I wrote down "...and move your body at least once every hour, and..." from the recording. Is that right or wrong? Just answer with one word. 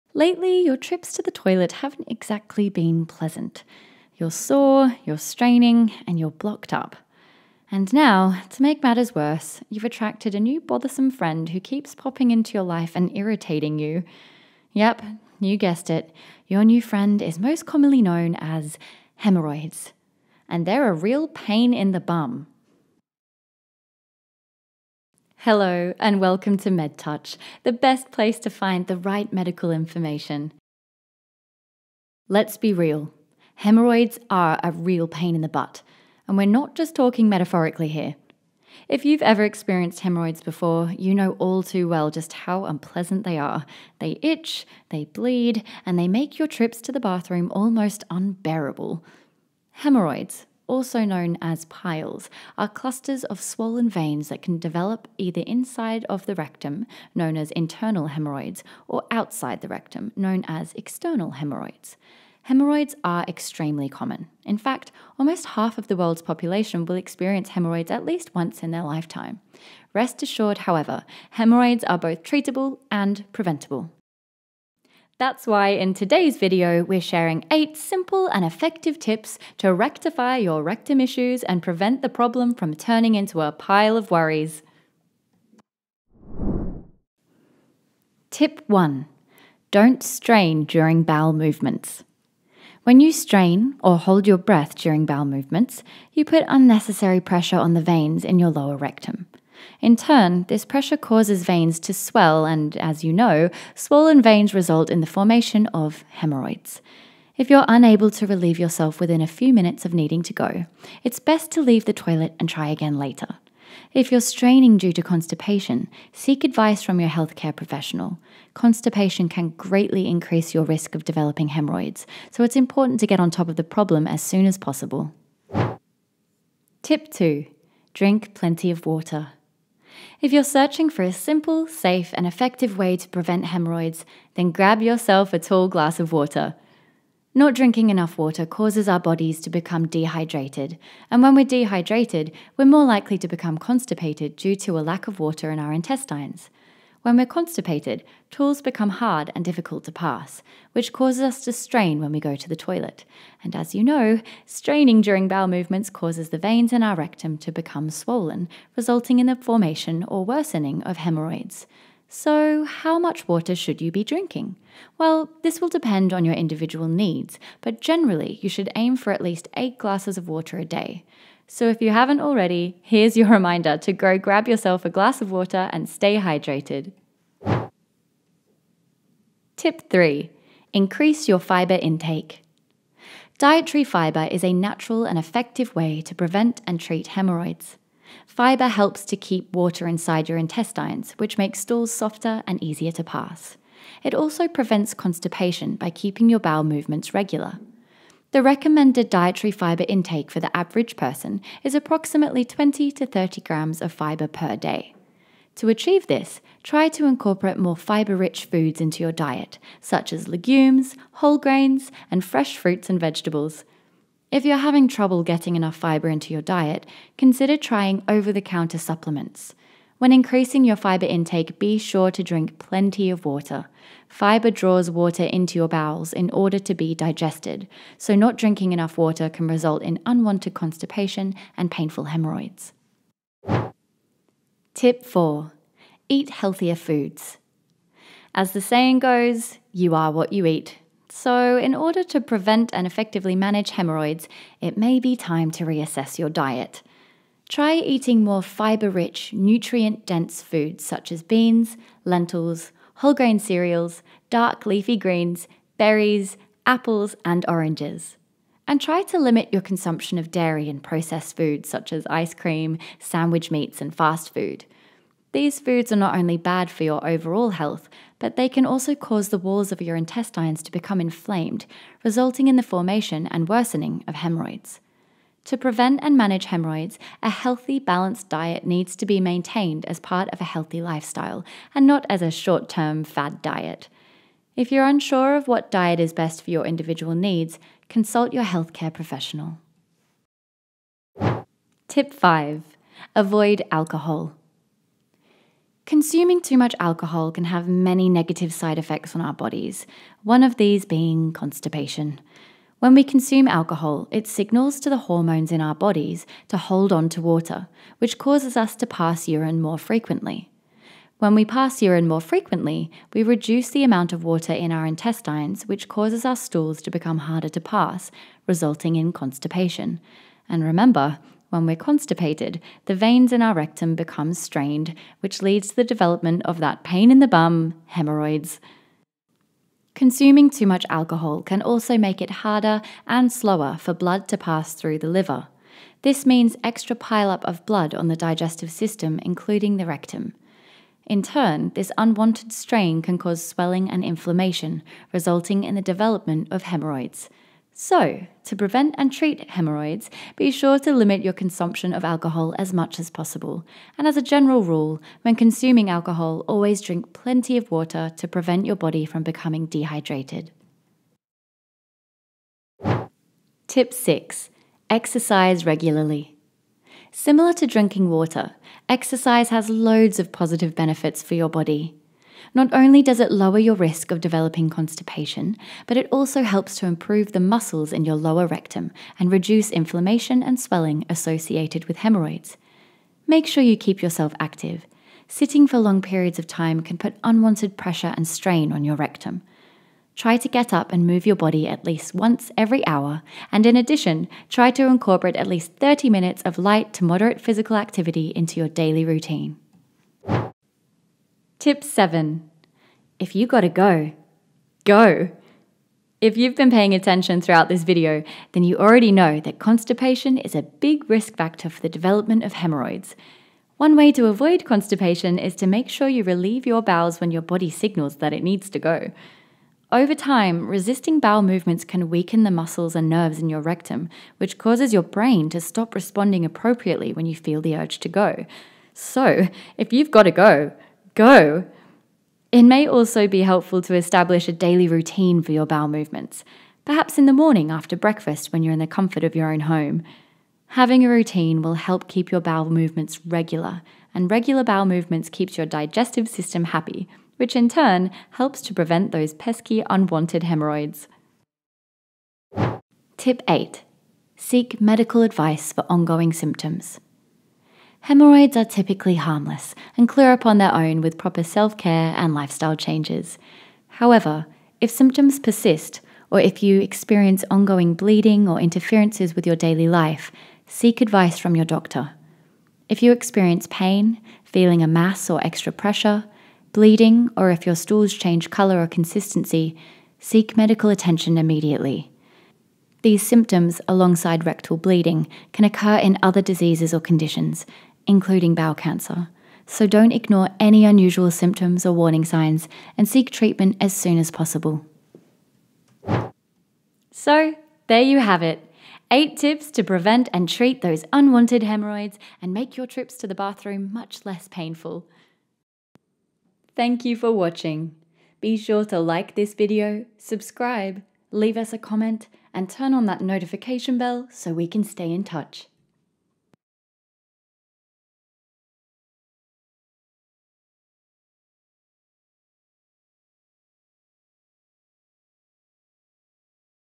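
right.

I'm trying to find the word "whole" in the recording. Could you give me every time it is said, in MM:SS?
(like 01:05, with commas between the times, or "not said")
03:31, 04:12.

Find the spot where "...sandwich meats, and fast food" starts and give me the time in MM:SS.
04:22.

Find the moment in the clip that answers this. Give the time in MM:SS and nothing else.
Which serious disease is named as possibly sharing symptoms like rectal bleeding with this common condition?
08:08.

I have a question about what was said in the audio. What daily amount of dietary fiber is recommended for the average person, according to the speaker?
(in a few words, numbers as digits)
20 to 30 grams.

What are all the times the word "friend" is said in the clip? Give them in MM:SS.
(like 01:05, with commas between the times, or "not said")
00:11, 00:16.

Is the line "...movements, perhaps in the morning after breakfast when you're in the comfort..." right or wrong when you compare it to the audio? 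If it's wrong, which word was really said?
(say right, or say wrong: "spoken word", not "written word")
right.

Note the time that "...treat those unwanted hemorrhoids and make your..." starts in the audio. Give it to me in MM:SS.
08:20.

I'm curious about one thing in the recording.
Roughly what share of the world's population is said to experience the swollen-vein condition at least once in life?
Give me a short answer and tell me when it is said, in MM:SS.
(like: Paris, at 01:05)
almost half, at 01:05.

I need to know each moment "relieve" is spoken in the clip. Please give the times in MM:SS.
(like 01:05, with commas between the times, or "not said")
01:48, 06:56.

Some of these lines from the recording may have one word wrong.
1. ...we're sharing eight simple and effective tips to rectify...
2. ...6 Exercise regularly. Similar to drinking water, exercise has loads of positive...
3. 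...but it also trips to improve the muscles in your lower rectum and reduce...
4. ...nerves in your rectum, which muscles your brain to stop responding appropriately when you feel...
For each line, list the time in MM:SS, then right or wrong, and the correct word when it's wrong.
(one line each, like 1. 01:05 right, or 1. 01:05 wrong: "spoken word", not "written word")
1. 01:16 right
2. 06:03 right
3. 06:15 wrong: "helps", not "trips"
4. 07:03 wrong: "causes", not "muscles".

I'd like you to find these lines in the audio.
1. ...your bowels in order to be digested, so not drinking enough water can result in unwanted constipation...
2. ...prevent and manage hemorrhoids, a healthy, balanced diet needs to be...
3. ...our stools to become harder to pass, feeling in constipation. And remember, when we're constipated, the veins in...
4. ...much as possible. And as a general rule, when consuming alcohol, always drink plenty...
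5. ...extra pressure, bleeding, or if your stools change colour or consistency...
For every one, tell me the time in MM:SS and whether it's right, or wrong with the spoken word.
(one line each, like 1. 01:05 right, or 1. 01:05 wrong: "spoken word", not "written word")
1. 03:45 right
2. 04:35 right
3. 05:16 wrong: "resulting", not "feeling"
4. 05:52 right
5. 07:55 right.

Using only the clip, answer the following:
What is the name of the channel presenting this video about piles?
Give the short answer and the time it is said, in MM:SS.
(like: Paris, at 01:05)
Medtuch, at 00:26.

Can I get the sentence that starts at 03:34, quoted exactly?
If you're having trouble getting enough fiber into your diet, consider trying over the counter supplements.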